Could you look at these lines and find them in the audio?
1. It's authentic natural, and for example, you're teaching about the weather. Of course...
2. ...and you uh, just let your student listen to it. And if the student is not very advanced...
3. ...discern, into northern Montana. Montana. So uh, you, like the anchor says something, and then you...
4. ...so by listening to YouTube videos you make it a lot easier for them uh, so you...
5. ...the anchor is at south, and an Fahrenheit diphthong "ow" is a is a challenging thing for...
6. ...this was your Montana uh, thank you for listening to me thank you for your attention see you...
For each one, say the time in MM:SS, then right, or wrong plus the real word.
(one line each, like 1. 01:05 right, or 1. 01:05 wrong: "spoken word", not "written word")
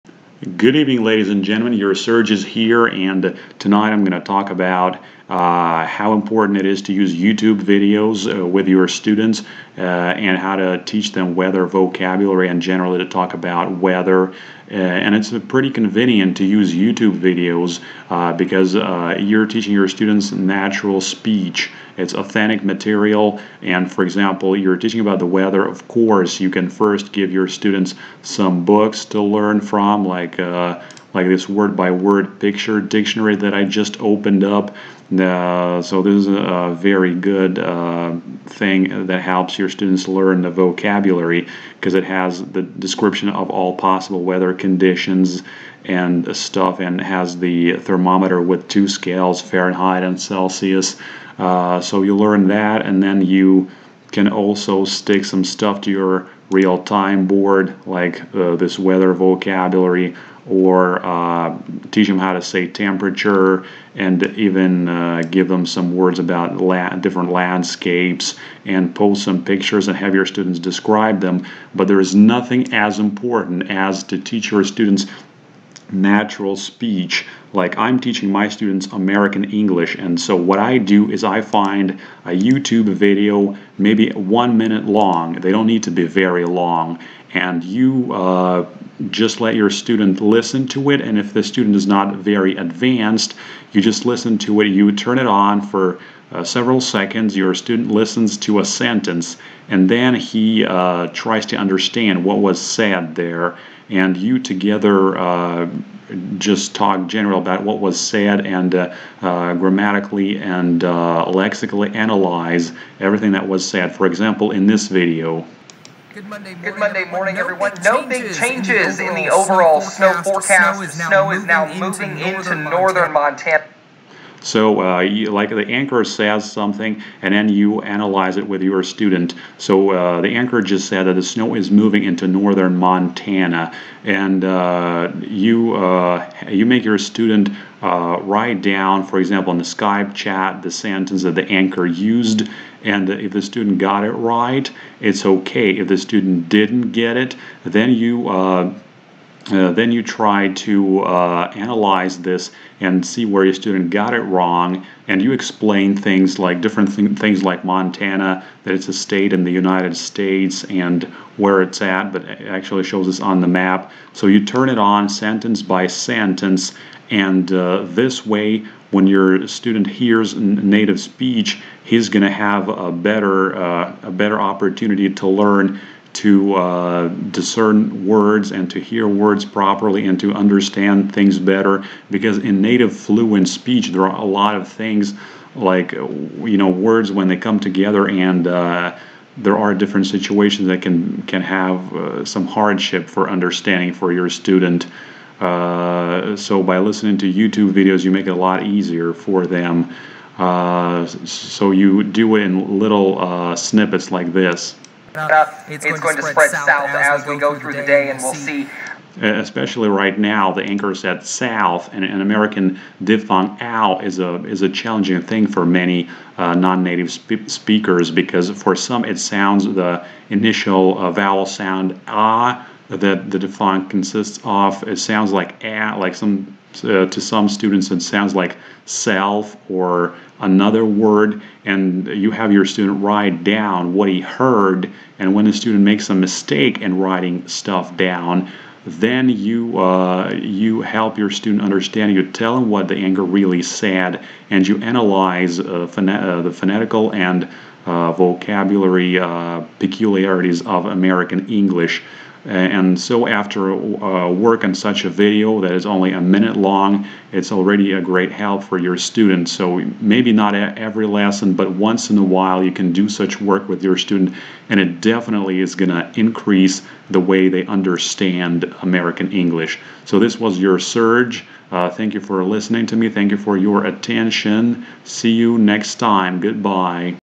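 1. 00:21 wrong: "material", not "natural"
2. 01:27 right
3. 02:02 wrong: "northern", not "discern"
4. 03:16 right
5. 03:30 wrong: "American", not "Fahrenheit"
6. 04:30 wrong: "Serge", not "Montana".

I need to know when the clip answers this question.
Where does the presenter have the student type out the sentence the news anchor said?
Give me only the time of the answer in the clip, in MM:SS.
02:19.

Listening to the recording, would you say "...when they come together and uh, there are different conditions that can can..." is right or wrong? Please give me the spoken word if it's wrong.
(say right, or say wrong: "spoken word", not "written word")
wrong: "situations", not "conditions".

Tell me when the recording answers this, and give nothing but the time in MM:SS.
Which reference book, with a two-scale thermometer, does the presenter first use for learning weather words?
00:31.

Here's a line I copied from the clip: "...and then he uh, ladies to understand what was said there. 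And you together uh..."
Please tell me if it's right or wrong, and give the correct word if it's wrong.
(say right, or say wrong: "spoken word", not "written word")
wrong: "tries", not "ladies".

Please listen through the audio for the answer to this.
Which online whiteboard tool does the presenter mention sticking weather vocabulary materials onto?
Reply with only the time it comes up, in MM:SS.
00:56.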